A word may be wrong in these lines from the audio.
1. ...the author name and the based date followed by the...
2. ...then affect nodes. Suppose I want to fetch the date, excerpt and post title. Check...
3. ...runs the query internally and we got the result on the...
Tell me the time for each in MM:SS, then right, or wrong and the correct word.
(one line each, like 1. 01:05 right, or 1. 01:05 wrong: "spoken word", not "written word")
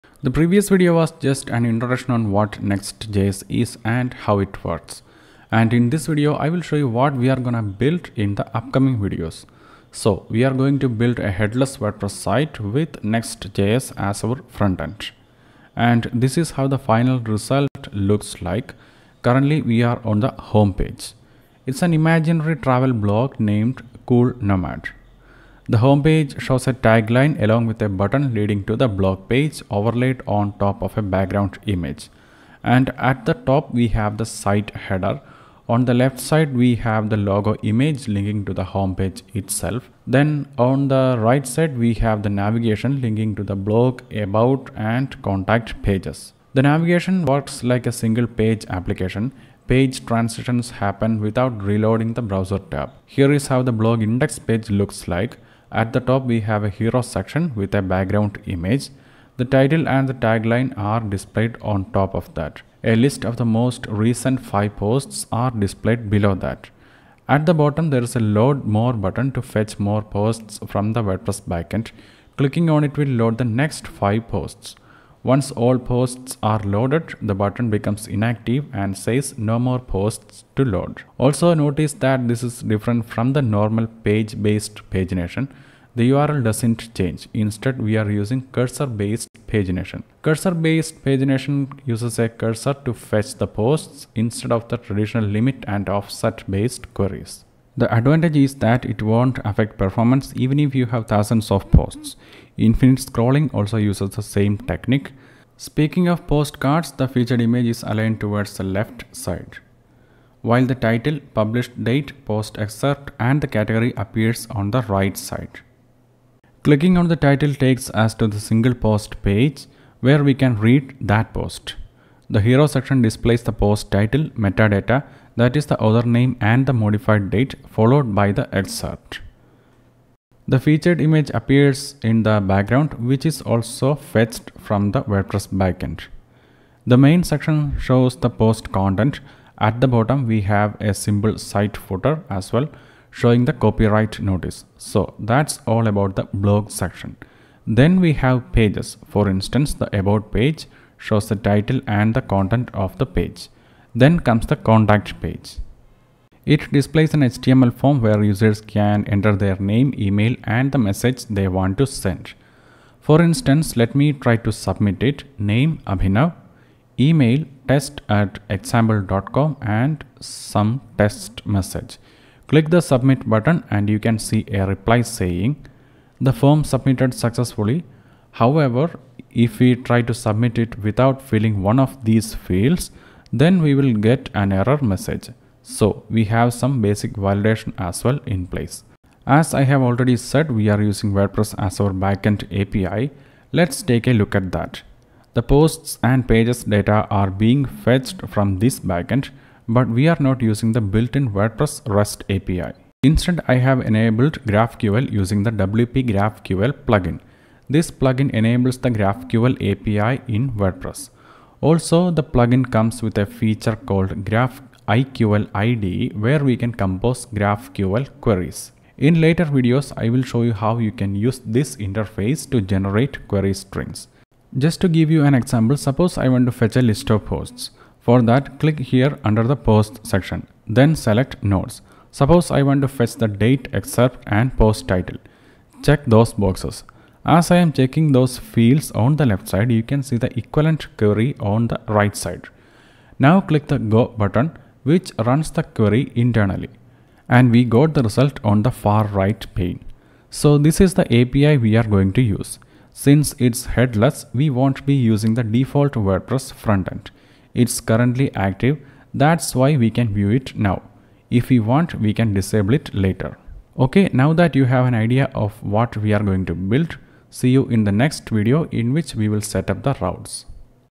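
1. 02:05 wrong: "modified", not "based"
2. 03:50 wrong: "select", not "affect"
3. 04:05 right.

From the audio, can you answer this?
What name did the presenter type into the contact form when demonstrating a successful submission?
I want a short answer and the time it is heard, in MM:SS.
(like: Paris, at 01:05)
Abhinav, at 02:45.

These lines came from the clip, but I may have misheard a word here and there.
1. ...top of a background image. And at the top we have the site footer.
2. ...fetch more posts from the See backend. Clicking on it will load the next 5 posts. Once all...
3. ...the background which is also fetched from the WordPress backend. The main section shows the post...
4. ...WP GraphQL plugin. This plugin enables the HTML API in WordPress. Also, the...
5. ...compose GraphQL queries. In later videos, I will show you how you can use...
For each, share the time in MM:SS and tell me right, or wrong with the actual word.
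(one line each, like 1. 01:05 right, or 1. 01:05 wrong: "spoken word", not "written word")
1. 00:30 wrong: "header", not "footer"
2. 01:09 wrong: "WordPress", not "See"
3. 02:12 right
4. 03:25 wrong: "GraphQL", not "HTML"
5. 03:36 right.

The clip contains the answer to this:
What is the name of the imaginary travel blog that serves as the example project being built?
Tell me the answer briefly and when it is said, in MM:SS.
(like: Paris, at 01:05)
Cool Nomad, at 00:24.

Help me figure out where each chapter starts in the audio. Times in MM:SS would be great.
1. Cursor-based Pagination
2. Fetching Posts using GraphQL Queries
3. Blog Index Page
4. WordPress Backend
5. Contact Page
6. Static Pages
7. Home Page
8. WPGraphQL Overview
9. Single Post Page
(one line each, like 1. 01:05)
1. 01:06
2. 04:03
3. 00:53
4. 03:07
5. 02:42
6. 02:27
7. 00:17
8. 03:27
9. 01:56.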